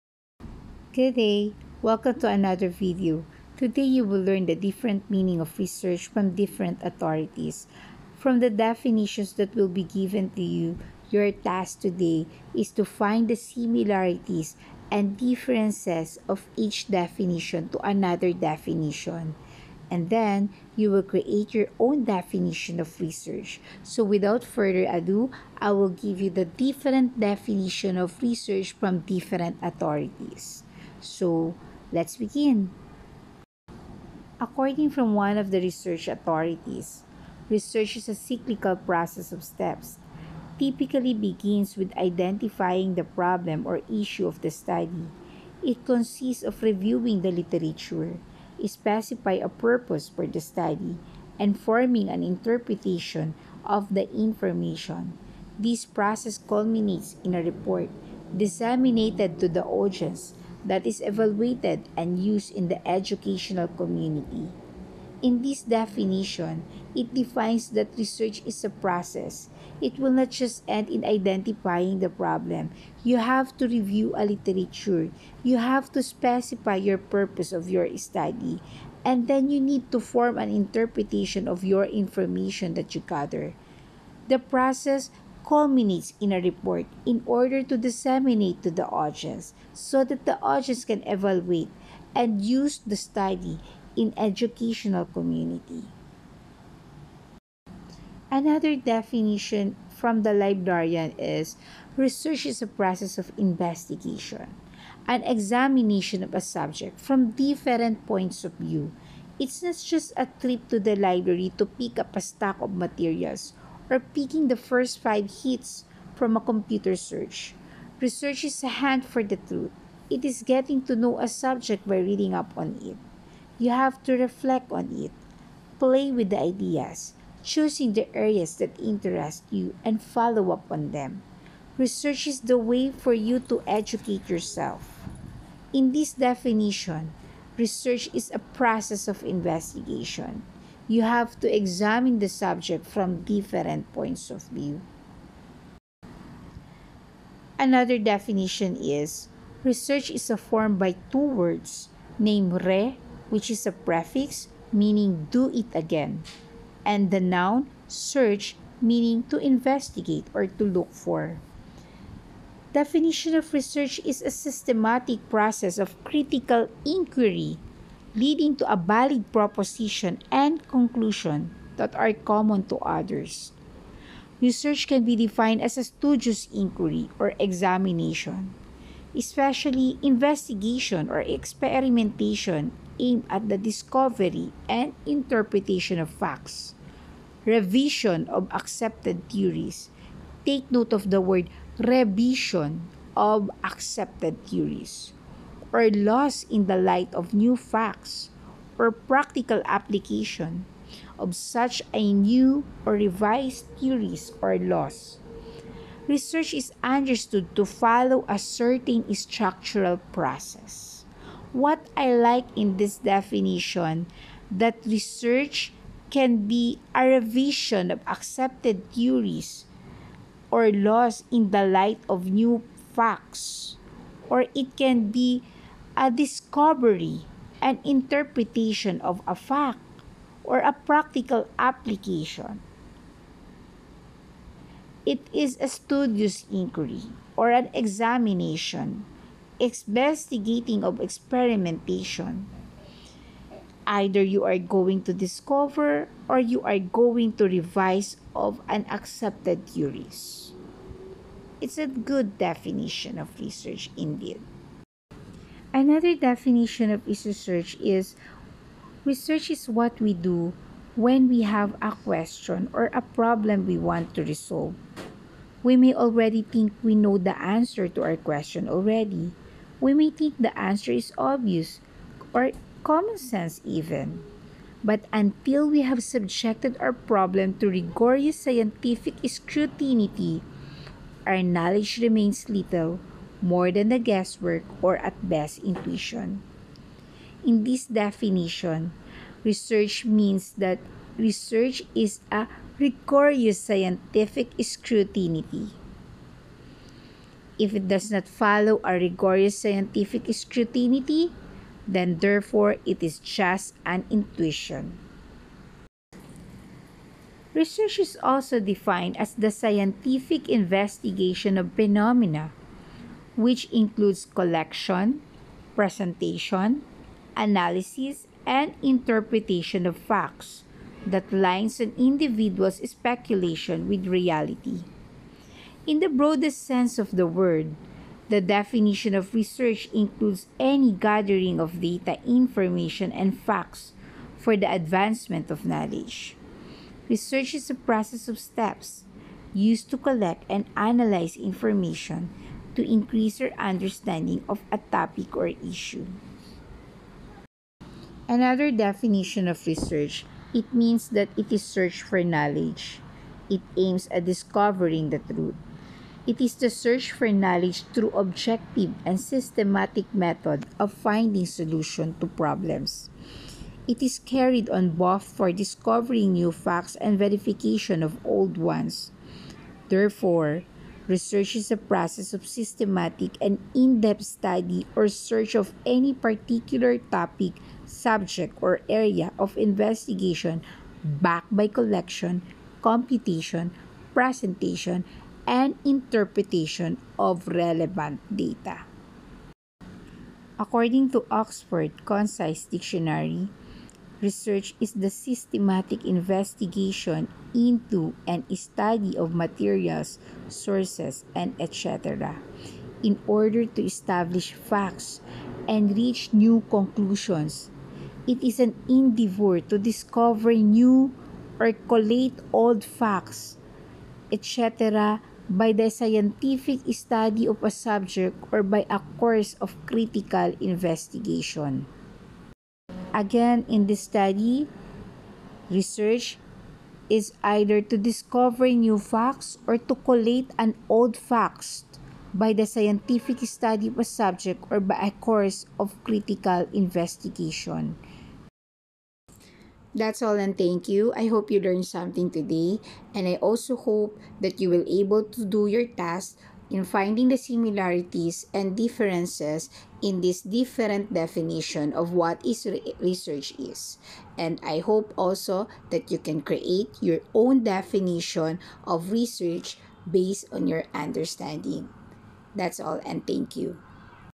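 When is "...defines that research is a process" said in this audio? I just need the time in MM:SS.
01:07.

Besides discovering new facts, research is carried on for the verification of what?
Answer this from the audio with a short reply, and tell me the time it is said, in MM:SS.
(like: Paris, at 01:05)
old ones, at 06:08.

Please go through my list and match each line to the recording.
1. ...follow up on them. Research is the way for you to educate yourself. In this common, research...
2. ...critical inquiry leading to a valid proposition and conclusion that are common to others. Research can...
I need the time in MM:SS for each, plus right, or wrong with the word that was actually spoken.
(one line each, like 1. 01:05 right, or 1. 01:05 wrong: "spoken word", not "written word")
1. 02:10 wrong: "definition", not "common"
2. 02:46 right.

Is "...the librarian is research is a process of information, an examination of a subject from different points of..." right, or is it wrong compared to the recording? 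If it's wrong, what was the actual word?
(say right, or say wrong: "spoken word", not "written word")
wrong: "investigation", not "information".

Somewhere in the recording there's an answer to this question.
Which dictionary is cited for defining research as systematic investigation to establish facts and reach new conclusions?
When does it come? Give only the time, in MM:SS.
06:31.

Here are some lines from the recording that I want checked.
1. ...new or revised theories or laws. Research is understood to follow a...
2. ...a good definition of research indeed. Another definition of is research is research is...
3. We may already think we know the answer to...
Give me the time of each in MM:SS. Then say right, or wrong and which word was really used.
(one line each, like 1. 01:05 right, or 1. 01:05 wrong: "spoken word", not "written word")
1. 03:22 right
2. 04:11 right
3. 04:25 right.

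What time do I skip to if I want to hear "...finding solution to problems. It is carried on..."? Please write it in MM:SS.
06:00.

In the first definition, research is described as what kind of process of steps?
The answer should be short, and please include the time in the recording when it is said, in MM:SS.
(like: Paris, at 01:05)
cyclical, at 00:38.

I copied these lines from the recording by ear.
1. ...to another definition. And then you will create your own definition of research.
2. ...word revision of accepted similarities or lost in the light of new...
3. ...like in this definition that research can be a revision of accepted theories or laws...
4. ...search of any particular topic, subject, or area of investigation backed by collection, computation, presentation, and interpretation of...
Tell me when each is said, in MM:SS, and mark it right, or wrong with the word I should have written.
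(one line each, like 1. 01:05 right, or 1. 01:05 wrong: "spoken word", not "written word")
1. 00:17 right
2. 03:11 wrong: "theories", not "similarities"
3. 03:32 right
4. 06:15 right.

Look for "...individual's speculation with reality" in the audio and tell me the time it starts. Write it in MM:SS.
05:21.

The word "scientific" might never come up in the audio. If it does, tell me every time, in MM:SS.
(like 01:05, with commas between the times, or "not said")
04:38, 04:53, 04:59, 05:09, 06:55, 07:12.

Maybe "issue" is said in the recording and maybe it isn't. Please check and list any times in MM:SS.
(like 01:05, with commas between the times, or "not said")
00:43, 05:45.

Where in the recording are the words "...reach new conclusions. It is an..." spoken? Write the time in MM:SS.
06:45.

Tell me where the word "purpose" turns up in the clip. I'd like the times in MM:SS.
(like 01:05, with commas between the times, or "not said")
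00:49, 01:16.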